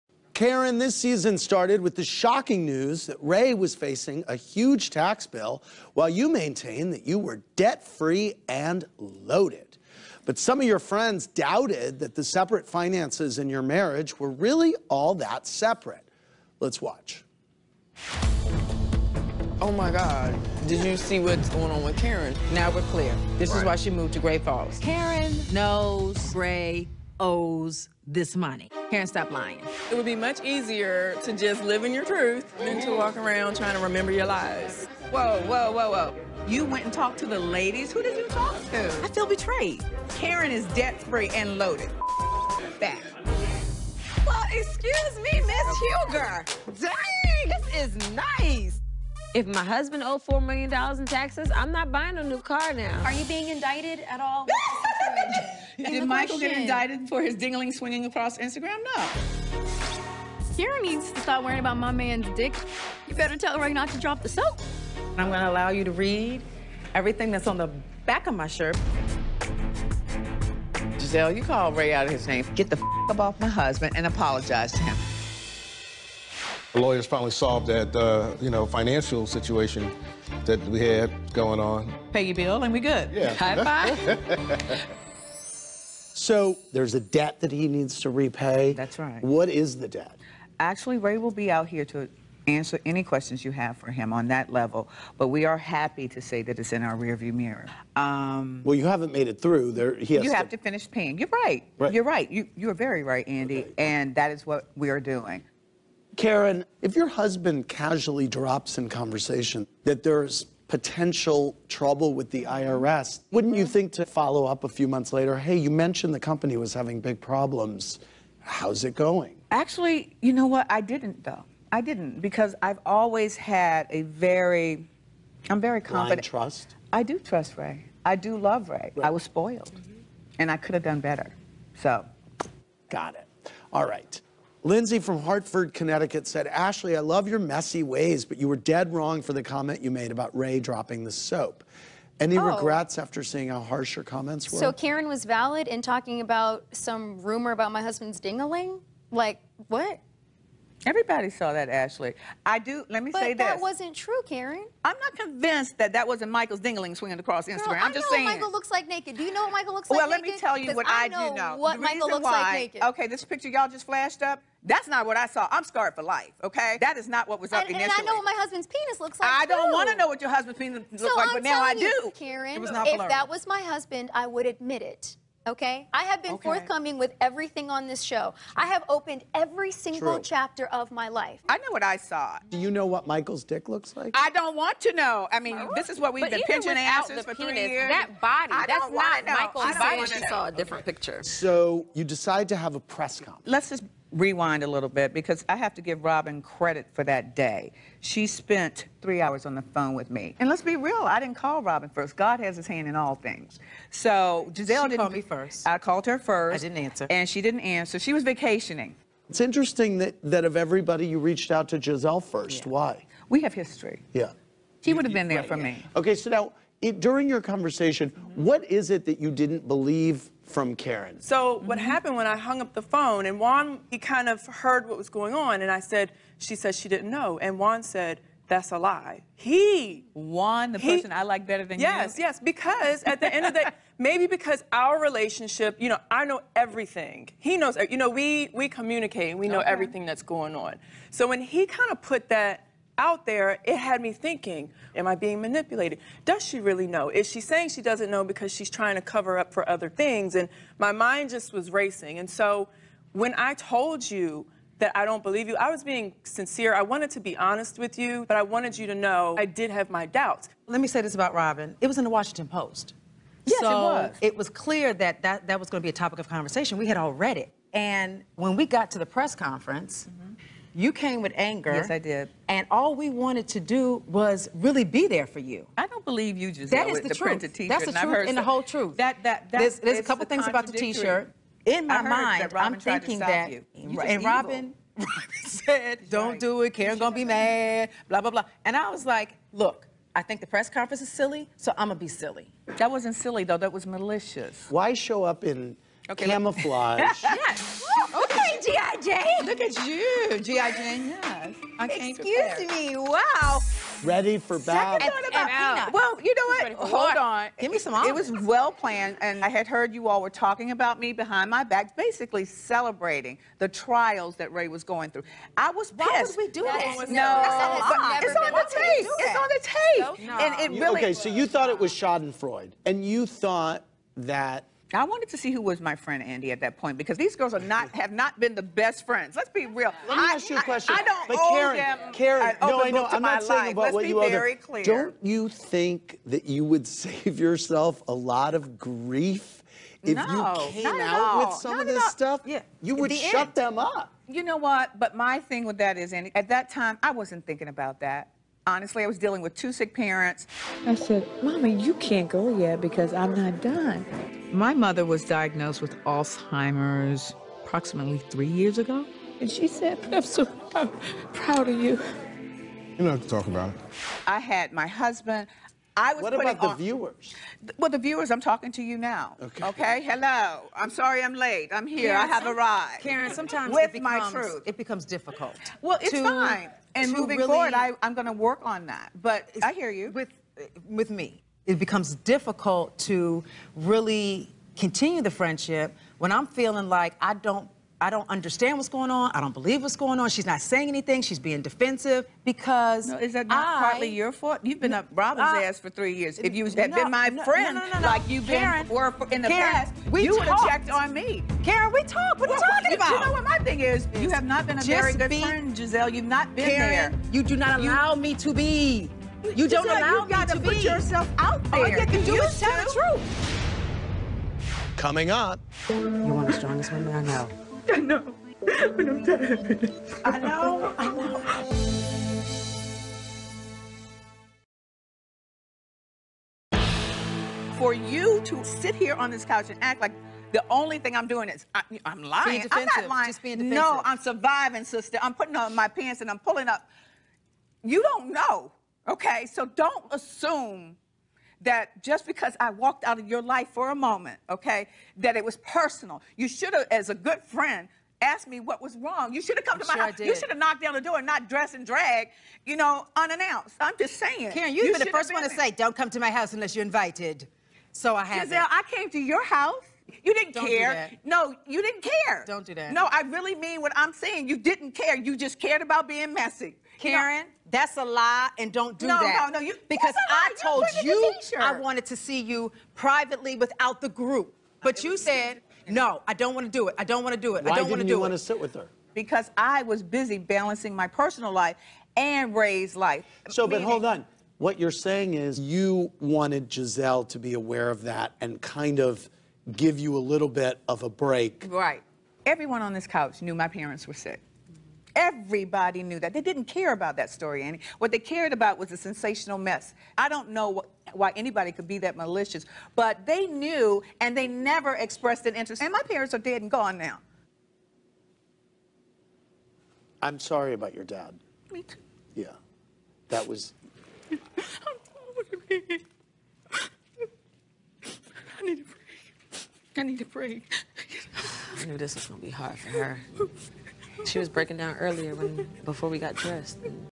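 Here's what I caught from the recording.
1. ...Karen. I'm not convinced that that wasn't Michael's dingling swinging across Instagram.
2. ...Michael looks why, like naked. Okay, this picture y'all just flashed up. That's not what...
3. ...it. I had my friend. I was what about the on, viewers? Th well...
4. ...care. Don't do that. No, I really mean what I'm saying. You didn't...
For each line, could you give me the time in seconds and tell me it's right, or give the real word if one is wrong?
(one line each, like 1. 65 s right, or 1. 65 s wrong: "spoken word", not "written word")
1. 154 s right
2. 161 s right
3. 363 s wrong: "husband", not "friend"
4. 462 s right.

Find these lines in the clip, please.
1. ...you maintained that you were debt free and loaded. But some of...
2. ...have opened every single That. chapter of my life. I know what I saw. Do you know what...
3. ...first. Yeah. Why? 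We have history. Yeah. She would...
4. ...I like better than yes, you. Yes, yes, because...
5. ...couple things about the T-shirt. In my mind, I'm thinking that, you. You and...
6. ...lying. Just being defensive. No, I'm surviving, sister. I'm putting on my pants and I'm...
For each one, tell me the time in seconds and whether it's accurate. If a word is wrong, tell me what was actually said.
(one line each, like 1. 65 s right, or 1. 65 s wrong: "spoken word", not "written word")
1. 6 s right
2. 178 s wrong: "True", not "That"
3. 212 s right
4. 231 s right
5. 280 s right
6. 433 s right.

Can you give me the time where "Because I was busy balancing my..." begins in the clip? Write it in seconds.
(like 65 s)
479 s.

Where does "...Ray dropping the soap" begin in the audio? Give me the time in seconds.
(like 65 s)
140 s.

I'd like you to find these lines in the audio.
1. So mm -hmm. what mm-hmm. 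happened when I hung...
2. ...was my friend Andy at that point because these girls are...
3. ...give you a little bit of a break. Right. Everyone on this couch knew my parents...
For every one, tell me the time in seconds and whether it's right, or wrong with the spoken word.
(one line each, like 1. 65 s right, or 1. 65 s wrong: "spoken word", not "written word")
1. 221 s right
2. 325 s right
3. 489 s right.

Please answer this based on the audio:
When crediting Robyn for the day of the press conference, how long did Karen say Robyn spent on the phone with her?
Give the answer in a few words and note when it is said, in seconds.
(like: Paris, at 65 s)
3 hours, at 199 s.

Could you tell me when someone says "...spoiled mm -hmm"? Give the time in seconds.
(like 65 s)
129 s.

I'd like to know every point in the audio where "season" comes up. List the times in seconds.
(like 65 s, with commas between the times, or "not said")
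0 s.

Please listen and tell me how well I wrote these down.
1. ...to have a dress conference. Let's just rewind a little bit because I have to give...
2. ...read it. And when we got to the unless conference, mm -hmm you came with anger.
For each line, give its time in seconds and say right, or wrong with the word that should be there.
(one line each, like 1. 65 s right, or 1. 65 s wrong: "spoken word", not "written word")
1. 192 s wrong: "press", not "dress"
2. 267 s wrong: "press", not "unless".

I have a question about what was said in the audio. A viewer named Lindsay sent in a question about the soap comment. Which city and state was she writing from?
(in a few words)
Hartford, Connecticut.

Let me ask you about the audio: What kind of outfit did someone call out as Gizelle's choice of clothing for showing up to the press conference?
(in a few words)
Camouflage.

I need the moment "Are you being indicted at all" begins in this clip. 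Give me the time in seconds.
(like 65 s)
53 s.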